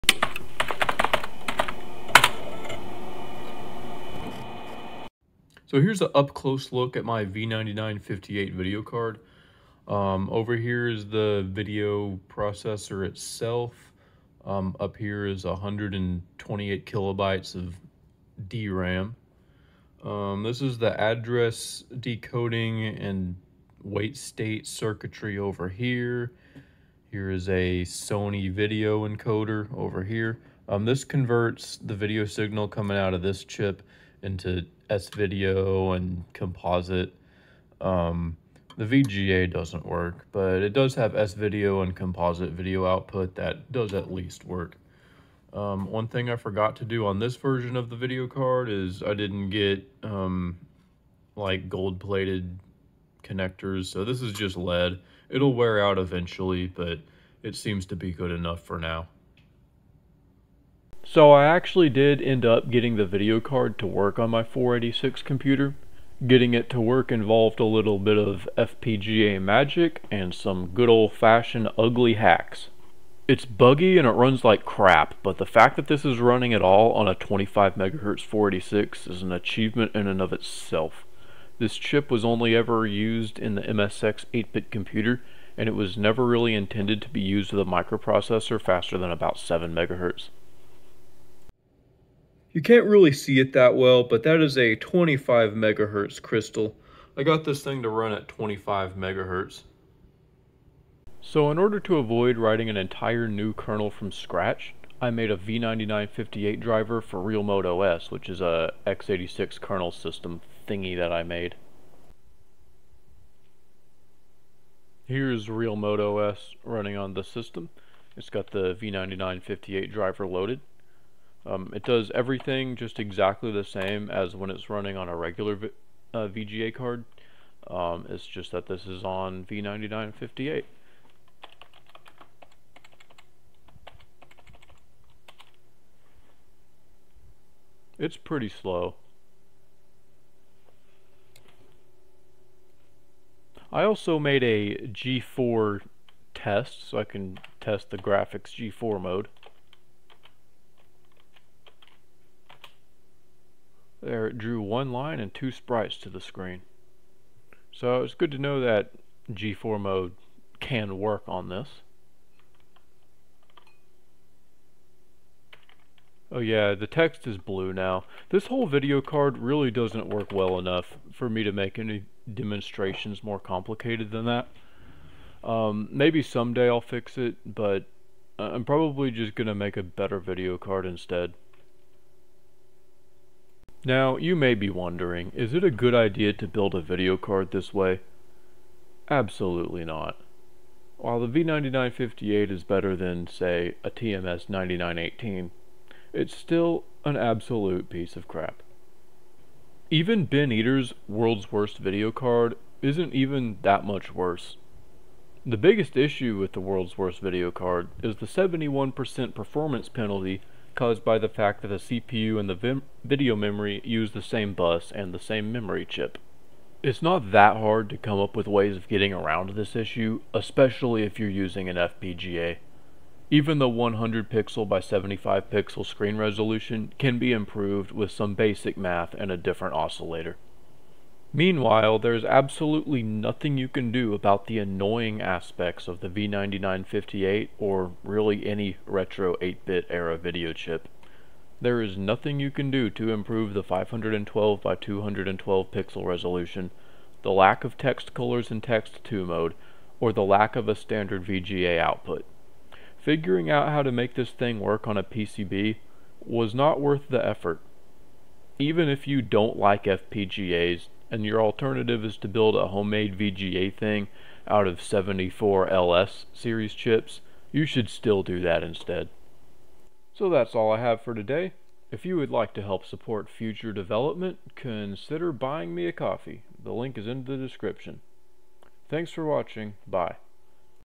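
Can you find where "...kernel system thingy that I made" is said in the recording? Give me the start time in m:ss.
1:49.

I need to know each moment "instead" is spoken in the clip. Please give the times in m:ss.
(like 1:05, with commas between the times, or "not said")
3:00, 4:28.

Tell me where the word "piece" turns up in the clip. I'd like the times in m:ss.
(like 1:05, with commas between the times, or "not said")
3:17.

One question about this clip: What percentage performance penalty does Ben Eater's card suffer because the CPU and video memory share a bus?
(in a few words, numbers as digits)
71%.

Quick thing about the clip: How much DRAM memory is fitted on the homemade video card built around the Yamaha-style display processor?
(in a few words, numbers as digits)
128 kilobytes.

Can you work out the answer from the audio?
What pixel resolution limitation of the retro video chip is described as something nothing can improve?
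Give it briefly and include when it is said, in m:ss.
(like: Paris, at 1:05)
512 by 212, at 4:03.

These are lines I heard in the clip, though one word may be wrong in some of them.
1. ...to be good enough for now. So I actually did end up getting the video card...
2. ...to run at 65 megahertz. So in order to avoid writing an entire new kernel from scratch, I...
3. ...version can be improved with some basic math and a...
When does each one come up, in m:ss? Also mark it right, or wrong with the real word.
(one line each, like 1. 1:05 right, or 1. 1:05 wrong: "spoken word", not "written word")
1. 0:57 right
2. 1:37 wrong: "25", not "65"
3. 3:46 wrong: "resolution", not "version".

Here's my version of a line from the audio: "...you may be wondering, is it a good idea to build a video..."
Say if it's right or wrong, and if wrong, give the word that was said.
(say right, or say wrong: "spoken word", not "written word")
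right.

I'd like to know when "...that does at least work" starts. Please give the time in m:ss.
0:43.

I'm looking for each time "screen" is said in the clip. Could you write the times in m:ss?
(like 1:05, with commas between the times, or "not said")
2:36, 3:45.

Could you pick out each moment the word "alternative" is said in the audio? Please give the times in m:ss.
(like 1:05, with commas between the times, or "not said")
4:21.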